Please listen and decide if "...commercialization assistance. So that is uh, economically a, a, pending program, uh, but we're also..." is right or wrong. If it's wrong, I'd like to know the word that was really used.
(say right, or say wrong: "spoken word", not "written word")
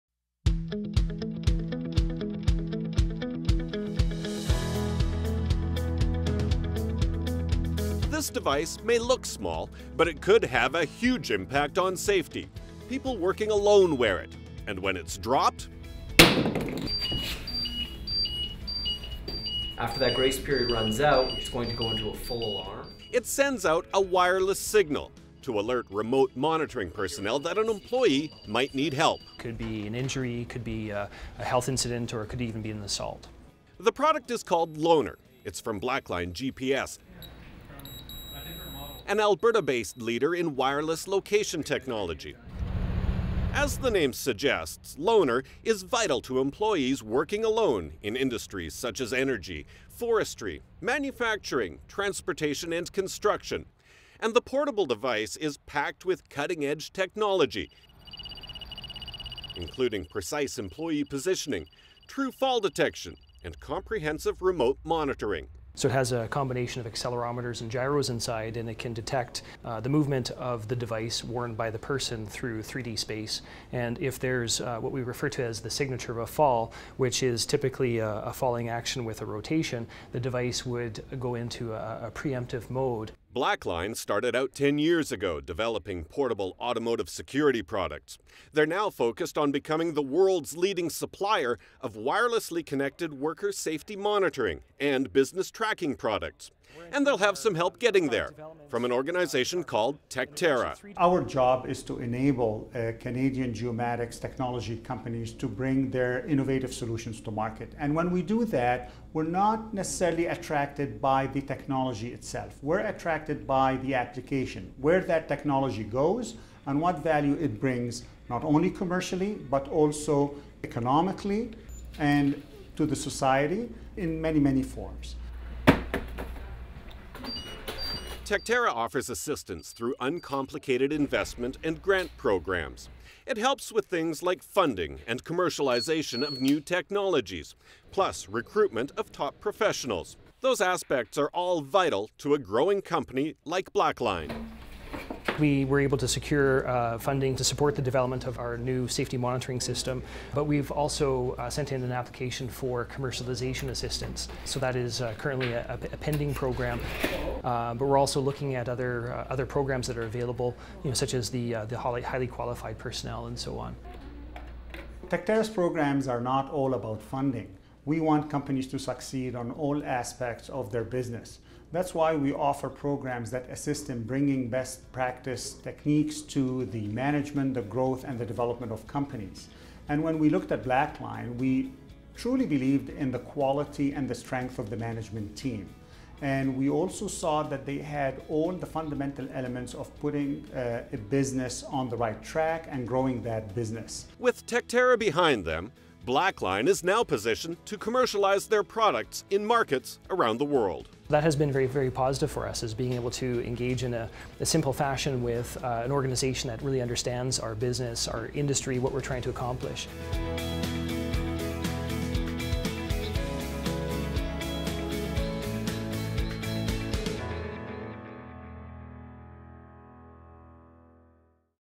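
wrong: "currently", not "economically".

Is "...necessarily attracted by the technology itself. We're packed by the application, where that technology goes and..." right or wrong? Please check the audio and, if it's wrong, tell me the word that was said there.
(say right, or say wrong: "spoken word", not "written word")
wrong: "attracted", not "packed".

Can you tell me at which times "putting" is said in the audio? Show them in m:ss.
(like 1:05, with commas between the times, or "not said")
3:10.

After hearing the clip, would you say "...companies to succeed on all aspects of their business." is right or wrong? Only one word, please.
right.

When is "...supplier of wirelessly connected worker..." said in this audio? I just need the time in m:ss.
1:30.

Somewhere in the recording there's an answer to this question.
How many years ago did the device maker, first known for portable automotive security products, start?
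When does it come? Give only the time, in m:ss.
1:24.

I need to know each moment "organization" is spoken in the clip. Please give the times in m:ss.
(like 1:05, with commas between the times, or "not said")
1:38, 3:25.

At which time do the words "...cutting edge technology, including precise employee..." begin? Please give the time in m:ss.
0:56.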